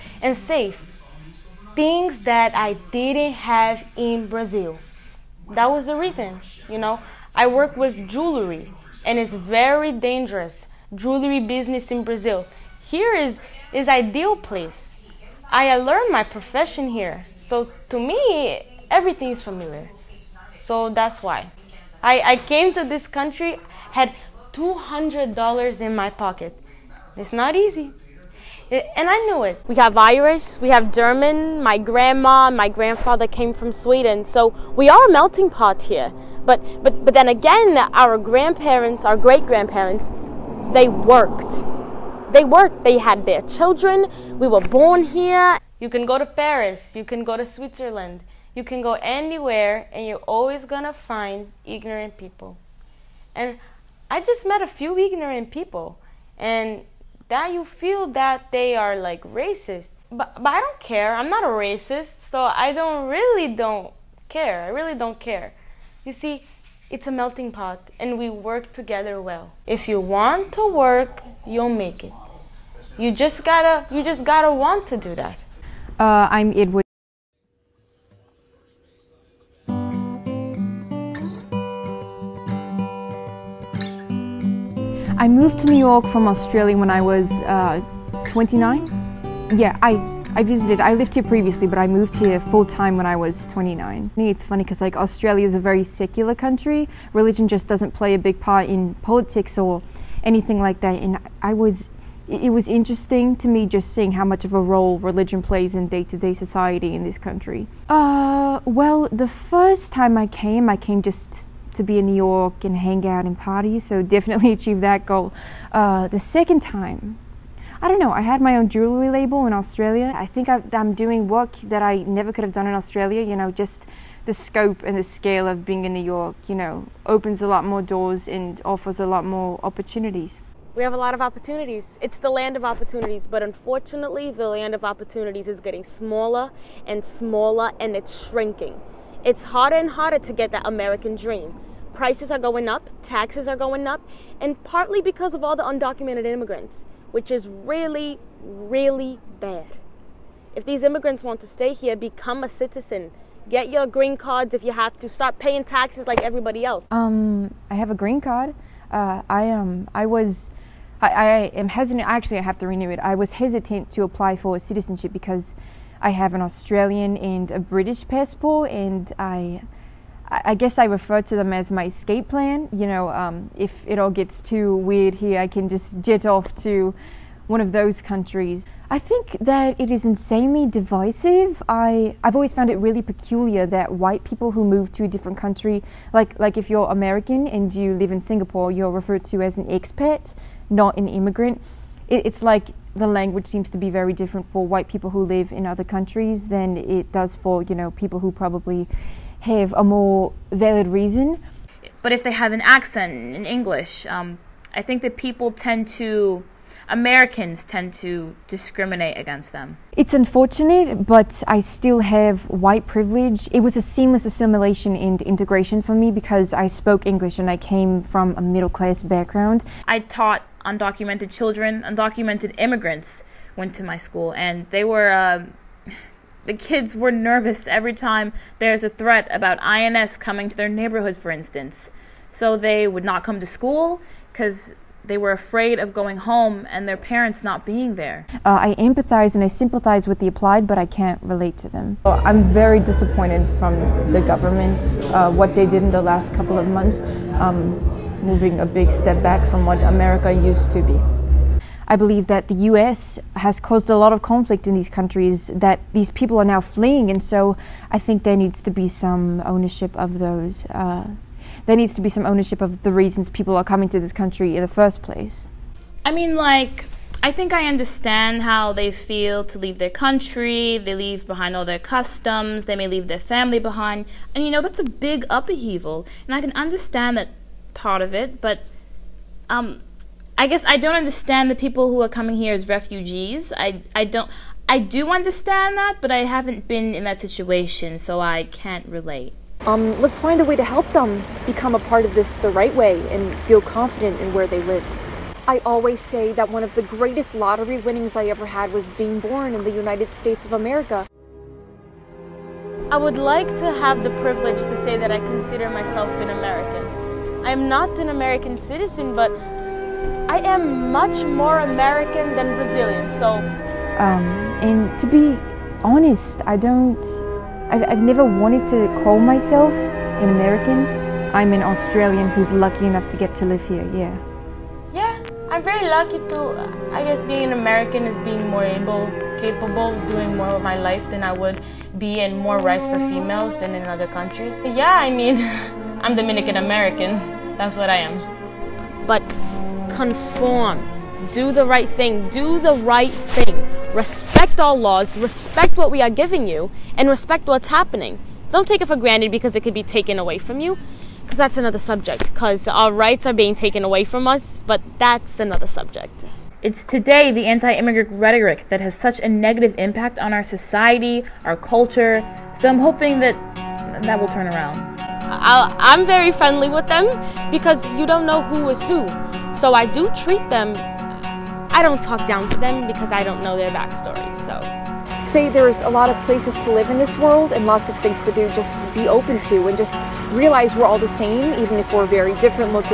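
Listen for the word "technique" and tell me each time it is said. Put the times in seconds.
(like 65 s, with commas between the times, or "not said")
not said.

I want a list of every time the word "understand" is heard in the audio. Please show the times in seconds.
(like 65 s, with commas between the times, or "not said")
267 s, 276 s, 280 s, 285 s.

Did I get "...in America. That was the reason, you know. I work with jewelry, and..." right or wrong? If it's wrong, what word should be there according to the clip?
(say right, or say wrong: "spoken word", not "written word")
wrong: "Brazil", not "America".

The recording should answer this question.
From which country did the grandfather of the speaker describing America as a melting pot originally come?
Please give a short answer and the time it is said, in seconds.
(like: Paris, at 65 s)
Sweden, at 33 s.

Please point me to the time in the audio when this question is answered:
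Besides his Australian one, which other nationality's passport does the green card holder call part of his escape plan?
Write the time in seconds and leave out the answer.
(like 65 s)
167 s.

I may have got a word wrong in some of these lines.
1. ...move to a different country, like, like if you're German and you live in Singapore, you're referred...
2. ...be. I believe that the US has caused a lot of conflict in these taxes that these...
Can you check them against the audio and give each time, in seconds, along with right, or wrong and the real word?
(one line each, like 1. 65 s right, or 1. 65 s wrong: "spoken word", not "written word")
1. 184 s wrong: "American", not "German"
2. 250 s wrong: "countries", not "taxes".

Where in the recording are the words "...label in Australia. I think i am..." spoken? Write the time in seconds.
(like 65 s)
119 s.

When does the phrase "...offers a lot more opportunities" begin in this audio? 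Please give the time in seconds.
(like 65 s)
128 s.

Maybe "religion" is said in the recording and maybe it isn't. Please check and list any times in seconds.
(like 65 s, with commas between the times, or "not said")
97 s, 104 s.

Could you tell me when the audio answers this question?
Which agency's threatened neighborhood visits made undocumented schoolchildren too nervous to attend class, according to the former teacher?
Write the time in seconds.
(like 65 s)
229 s.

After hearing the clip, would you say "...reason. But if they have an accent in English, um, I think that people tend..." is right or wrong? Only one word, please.
right.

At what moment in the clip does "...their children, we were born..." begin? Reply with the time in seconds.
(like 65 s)
43 s.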